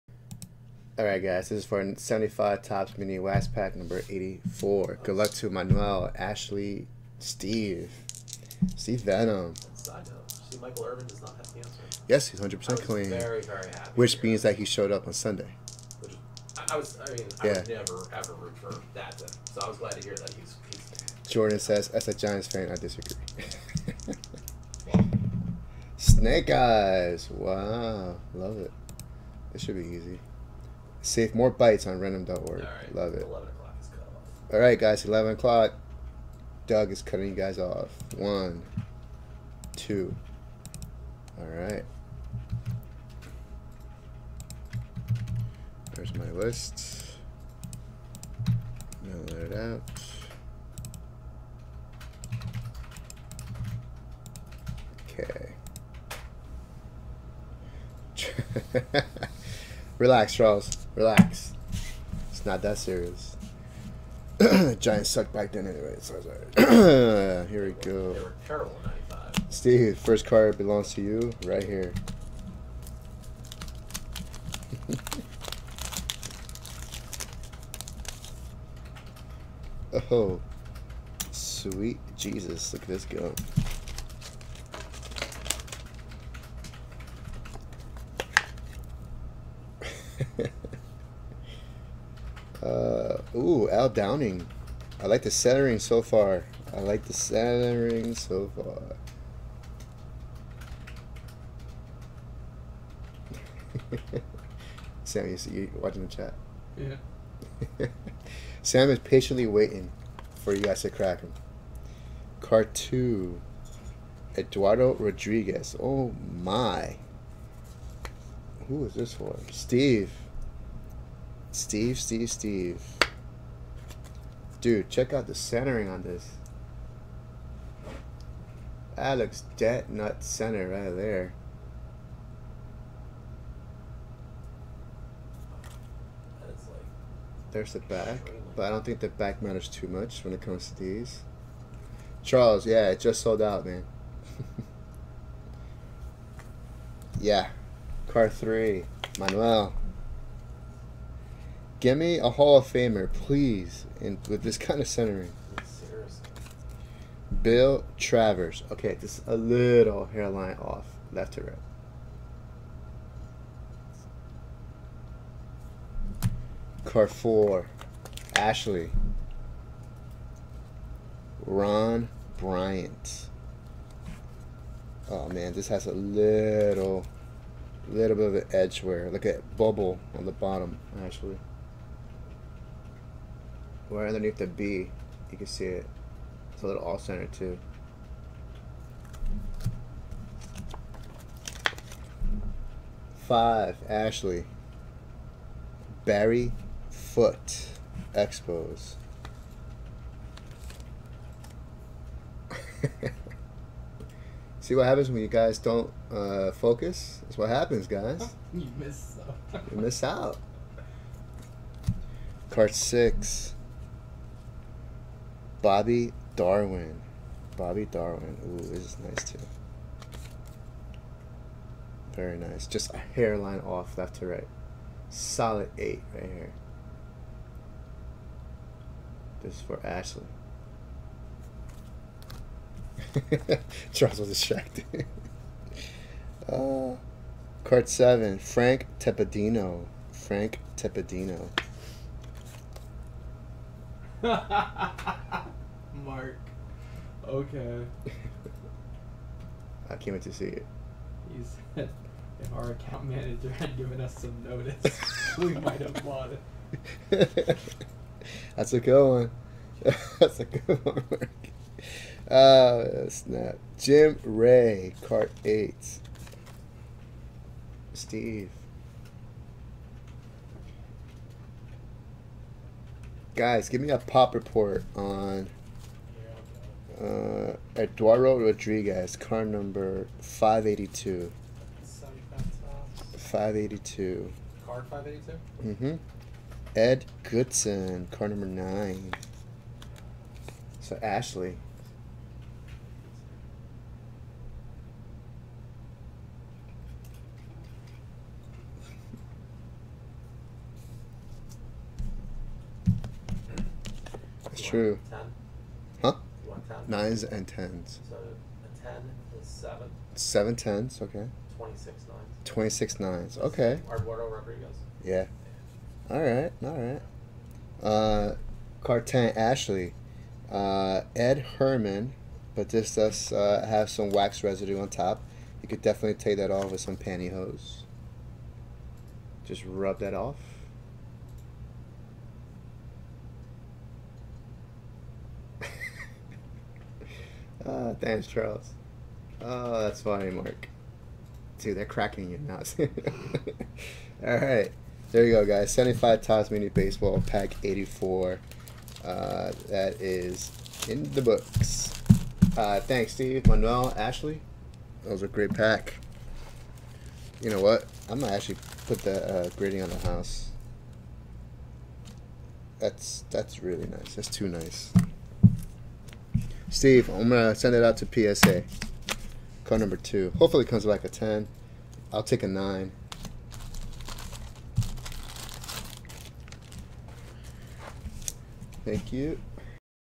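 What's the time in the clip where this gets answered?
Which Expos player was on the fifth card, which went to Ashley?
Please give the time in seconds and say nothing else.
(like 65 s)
196 s.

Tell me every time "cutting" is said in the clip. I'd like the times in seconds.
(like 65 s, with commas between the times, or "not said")
37 s.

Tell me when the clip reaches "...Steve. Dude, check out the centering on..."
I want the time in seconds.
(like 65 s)
122 s.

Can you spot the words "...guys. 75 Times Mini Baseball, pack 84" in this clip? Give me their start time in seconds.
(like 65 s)
345 s.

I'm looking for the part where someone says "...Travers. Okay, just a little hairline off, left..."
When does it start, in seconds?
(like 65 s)
157 s.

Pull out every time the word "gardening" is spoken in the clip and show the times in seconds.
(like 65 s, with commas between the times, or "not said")
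not said.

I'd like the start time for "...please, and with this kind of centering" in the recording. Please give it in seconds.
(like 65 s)
153 s.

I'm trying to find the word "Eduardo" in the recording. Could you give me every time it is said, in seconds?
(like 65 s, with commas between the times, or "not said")
114 s, 277 s, 313 s.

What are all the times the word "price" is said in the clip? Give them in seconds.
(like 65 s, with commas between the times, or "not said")
not said.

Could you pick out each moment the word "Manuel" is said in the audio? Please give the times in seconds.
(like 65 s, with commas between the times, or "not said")
5 s, 149 s, 353 s.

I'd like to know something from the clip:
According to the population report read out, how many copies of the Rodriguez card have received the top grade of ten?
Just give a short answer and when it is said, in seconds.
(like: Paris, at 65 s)
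7, at 310 s.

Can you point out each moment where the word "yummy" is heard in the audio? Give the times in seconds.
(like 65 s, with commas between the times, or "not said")
not said.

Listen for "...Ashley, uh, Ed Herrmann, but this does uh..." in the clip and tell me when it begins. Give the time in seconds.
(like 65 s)
319 s.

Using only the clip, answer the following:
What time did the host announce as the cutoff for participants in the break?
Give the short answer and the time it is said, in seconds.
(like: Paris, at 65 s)
11 o'clock, at 33 s.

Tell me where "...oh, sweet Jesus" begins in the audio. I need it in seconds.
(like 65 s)
80 s.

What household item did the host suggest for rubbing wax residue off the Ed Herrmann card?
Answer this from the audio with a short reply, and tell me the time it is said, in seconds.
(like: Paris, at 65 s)
pantyhose, at 326 s.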